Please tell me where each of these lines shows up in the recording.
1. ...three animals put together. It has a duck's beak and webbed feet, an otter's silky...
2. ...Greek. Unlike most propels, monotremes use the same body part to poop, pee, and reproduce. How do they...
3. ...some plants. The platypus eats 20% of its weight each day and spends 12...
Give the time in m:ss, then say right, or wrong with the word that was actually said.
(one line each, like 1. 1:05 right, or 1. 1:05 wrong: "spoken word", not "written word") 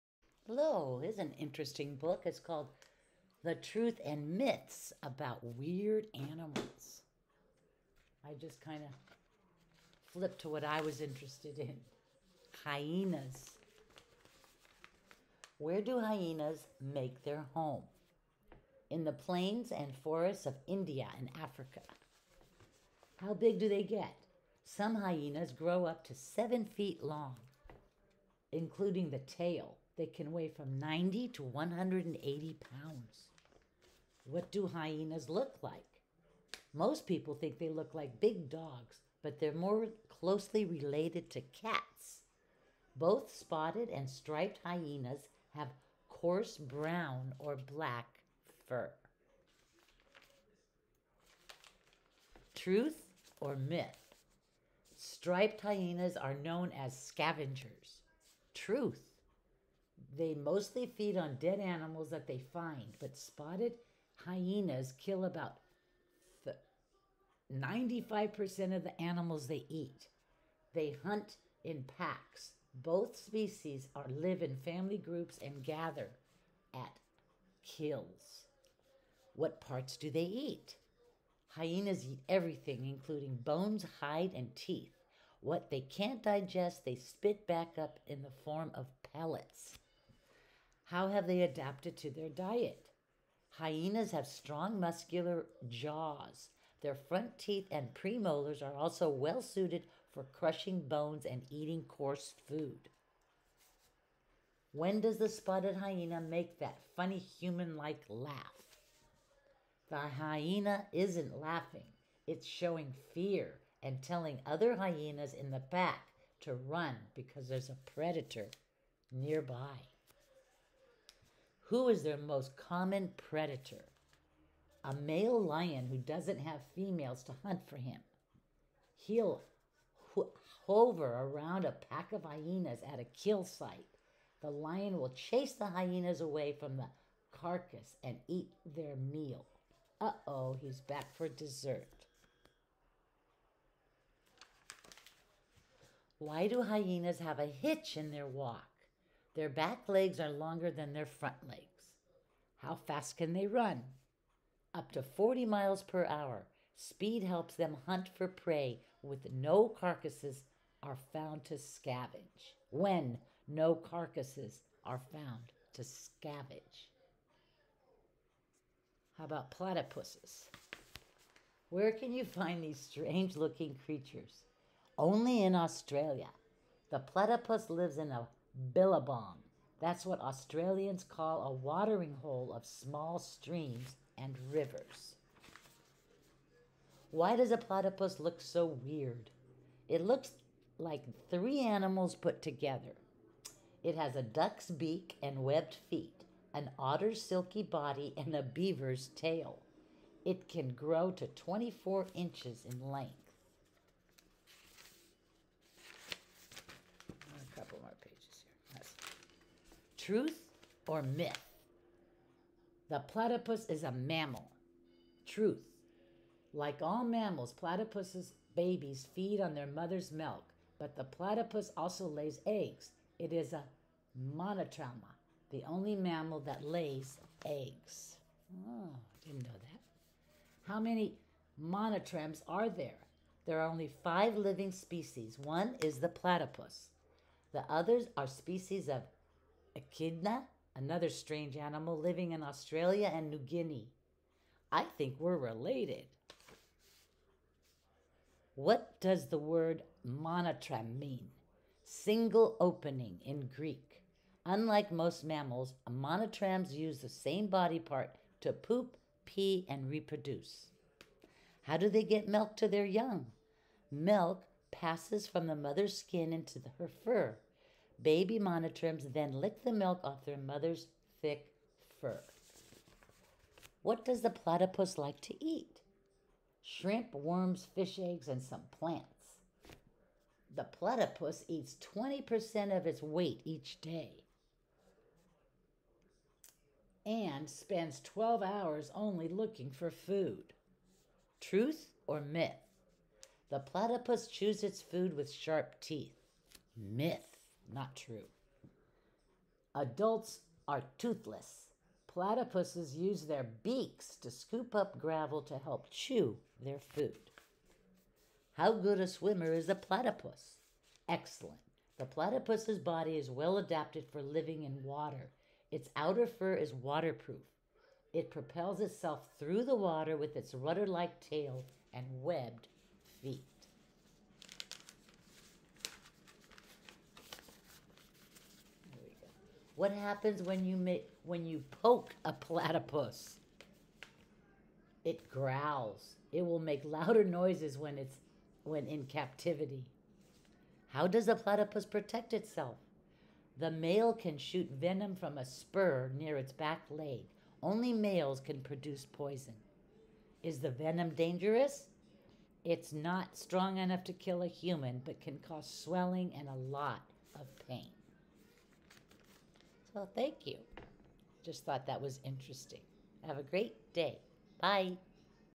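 1. 3:11 right
2. 4:13 wrong: "mammals", not "propels"
3. 4:38 right.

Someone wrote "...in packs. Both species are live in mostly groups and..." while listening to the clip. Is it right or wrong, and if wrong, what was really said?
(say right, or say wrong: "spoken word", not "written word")
wrong: "family", not "mostly".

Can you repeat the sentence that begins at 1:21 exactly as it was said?
Hyenas eat everything, including bones, hide, and teeth.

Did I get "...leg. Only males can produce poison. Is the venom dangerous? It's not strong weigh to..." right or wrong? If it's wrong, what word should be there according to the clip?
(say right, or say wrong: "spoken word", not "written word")
wrong: "enough", not "weigh".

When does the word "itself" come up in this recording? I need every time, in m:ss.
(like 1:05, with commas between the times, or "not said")
5:18, 5:42.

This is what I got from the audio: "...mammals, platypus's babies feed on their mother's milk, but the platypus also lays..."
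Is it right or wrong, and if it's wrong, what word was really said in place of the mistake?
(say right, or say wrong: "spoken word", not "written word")
right.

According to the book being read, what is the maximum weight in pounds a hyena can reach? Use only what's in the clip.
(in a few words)
180 pounds.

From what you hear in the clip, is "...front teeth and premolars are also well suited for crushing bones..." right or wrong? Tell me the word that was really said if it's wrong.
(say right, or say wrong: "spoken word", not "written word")
right.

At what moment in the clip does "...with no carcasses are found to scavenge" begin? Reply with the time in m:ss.
2:39.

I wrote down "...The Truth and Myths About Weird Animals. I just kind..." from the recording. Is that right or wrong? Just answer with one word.
right.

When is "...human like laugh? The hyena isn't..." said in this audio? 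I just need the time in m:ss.
1:47.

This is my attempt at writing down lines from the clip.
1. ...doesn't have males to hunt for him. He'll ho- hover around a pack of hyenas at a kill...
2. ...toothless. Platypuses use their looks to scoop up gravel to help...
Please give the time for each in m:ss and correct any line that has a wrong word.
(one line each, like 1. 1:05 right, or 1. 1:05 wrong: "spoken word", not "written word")
1. 2:05 wrong: "females", not "males"
2. 5:00 wrong: "beaks", not "looks".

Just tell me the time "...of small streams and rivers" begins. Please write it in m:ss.
3:02.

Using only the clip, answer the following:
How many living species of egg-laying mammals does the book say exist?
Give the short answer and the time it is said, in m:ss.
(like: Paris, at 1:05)
5, at 3:54.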